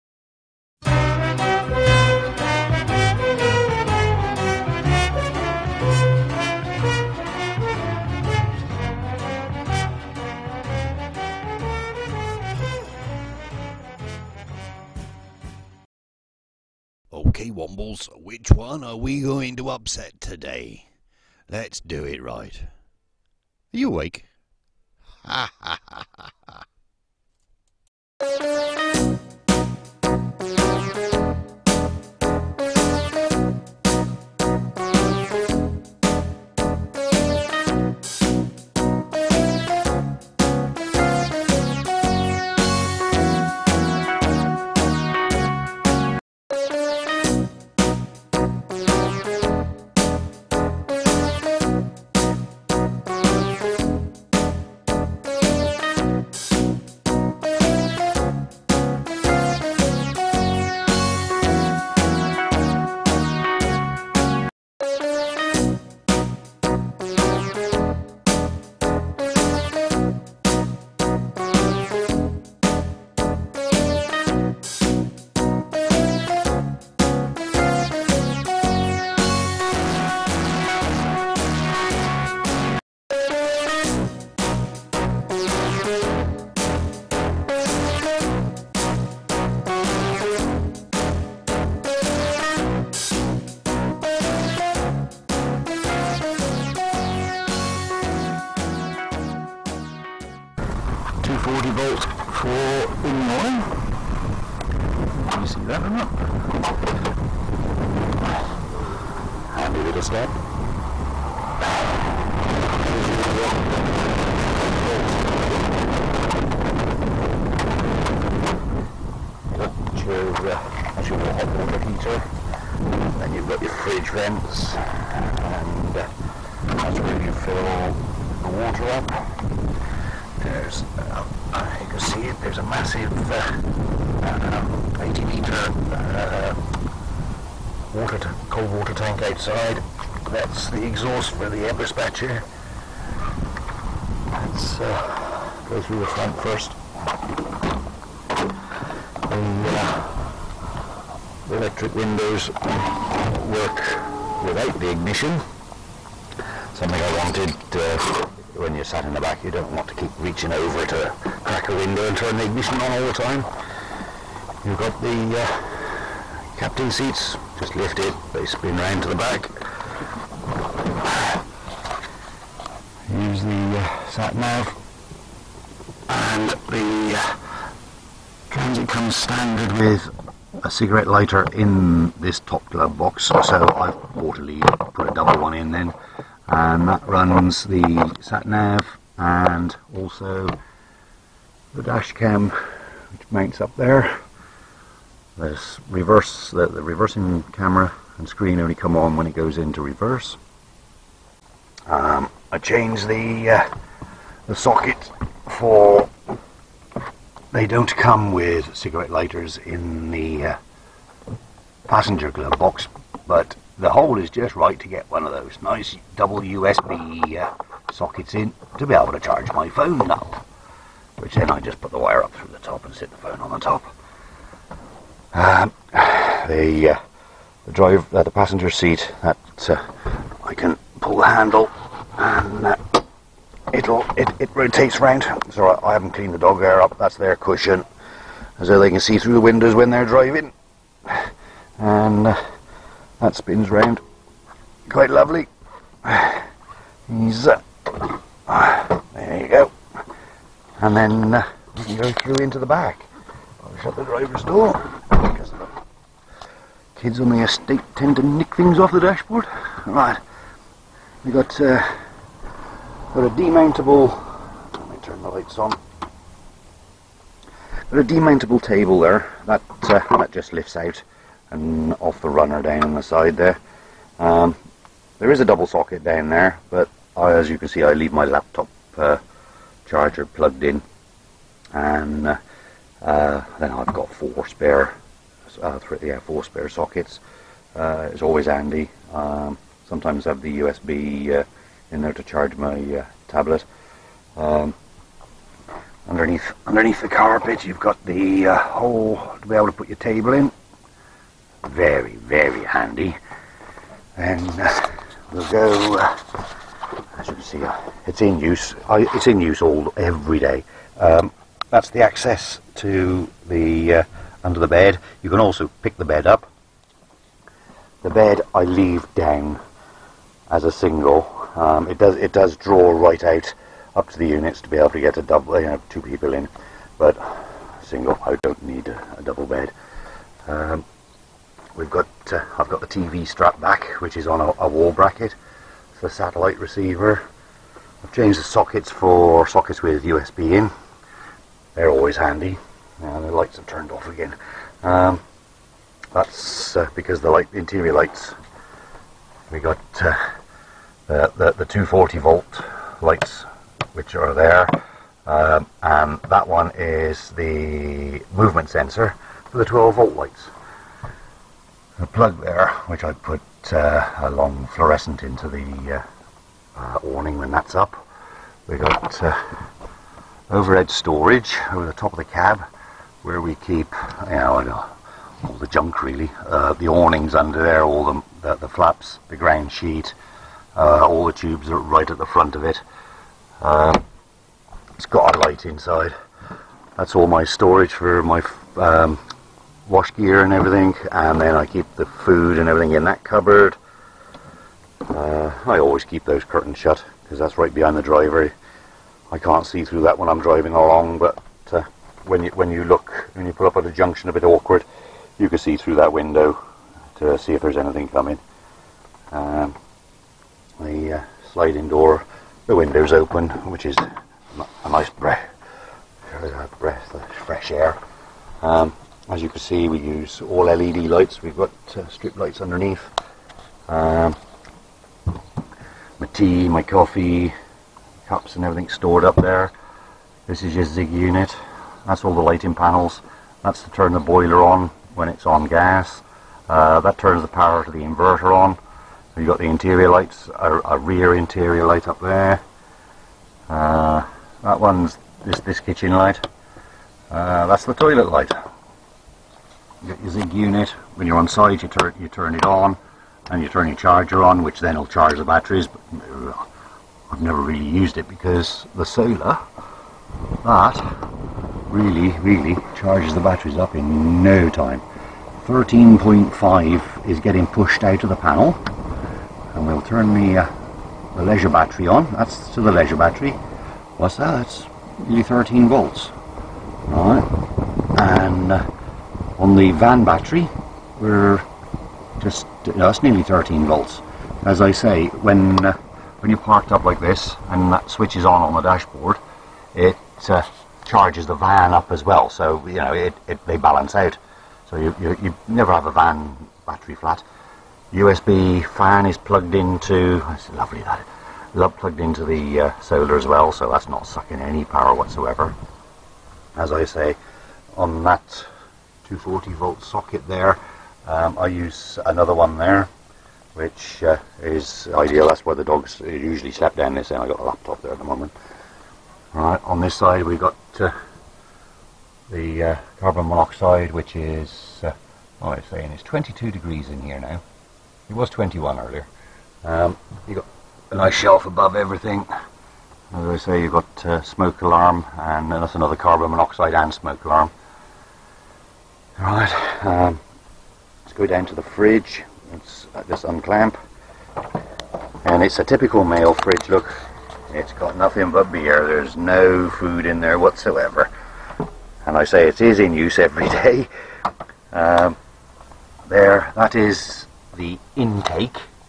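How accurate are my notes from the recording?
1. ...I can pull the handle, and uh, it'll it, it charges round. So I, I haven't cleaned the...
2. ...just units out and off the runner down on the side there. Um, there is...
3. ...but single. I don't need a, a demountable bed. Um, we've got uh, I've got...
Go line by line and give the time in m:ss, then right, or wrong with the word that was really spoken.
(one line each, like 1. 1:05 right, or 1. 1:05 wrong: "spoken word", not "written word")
1. 3:50 wrong: "rotates", not "charges"
2. 4:30 wrong: "lifts", not "units"
3. 5:26 wrong: "double", not "demountable".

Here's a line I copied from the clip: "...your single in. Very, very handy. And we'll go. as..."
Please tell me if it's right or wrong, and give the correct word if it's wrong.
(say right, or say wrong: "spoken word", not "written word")
wrong: "table", not "single".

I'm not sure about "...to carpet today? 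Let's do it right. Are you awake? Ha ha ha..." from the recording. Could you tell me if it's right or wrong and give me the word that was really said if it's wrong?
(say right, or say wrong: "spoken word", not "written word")
wrong: "upset", not "carpet".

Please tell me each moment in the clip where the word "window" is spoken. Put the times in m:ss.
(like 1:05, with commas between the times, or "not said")
2:31, 2:41, 3:59, 6:46, 6:52.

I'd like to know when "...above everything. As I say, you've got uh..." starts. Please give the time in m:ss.
8:51.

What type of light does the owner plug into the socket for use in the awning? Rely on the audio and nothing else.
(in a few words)
long fluorescent.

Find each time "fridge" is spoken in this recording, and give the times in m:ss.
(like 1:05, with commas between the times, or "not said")
2:03, 9:01, 9:06.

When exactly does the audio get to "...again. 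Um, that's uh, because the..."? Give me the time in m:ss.
5:44.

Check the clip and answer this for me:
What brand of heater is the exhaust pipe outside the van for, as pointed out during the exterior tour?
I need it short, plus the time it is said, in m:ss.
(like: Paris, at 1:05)
Eberspacher, at 2:21.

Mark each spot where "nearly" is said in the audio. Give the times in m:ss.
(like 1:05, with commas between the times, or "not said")
7:55, 8:03.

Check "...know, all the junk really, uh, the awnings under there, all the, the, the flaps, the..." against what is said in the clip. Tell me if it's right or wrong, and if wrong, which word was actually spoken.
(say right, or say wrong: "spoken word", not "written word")
right.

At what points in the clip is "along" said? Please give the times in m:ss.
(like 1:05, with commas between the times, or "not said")
6:40.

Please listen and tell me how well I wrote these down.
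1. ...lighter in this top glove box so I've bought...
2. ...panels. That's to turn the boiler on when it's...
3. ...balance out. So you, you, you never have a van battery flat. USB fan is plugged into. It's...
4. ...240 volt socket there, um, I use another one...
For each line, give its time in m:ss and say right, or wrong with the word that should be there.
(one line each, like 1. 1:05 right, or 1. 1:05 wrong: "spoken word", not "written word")
1. 3:01 right
2. 7:12 right
3. 8:13 right
4. 8:29 right.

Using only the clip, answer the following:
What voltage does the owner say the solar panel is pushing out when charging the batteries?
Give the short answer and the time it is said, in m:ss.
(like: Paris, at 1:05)
13.5, at 7:45.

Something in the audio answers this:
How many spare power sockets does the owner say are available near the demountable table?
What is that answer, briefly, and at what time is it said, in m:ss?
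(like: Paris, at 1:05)
4, at 4:44.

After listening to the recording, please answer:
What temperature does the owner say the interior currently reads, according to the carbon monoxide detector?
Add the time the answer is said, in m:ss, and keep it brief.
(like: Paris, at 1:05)
22 degrees, at 8:46.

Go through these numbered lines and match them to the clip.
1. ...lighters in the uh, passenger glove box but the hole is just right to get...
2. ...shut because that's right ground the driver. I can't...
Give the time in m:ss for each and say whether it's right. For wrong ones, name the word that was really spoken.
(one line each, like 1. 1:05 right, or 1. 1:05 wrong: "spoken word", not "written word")
1. 3:29 right
2. 6:36 wrong: "behind", not "ground".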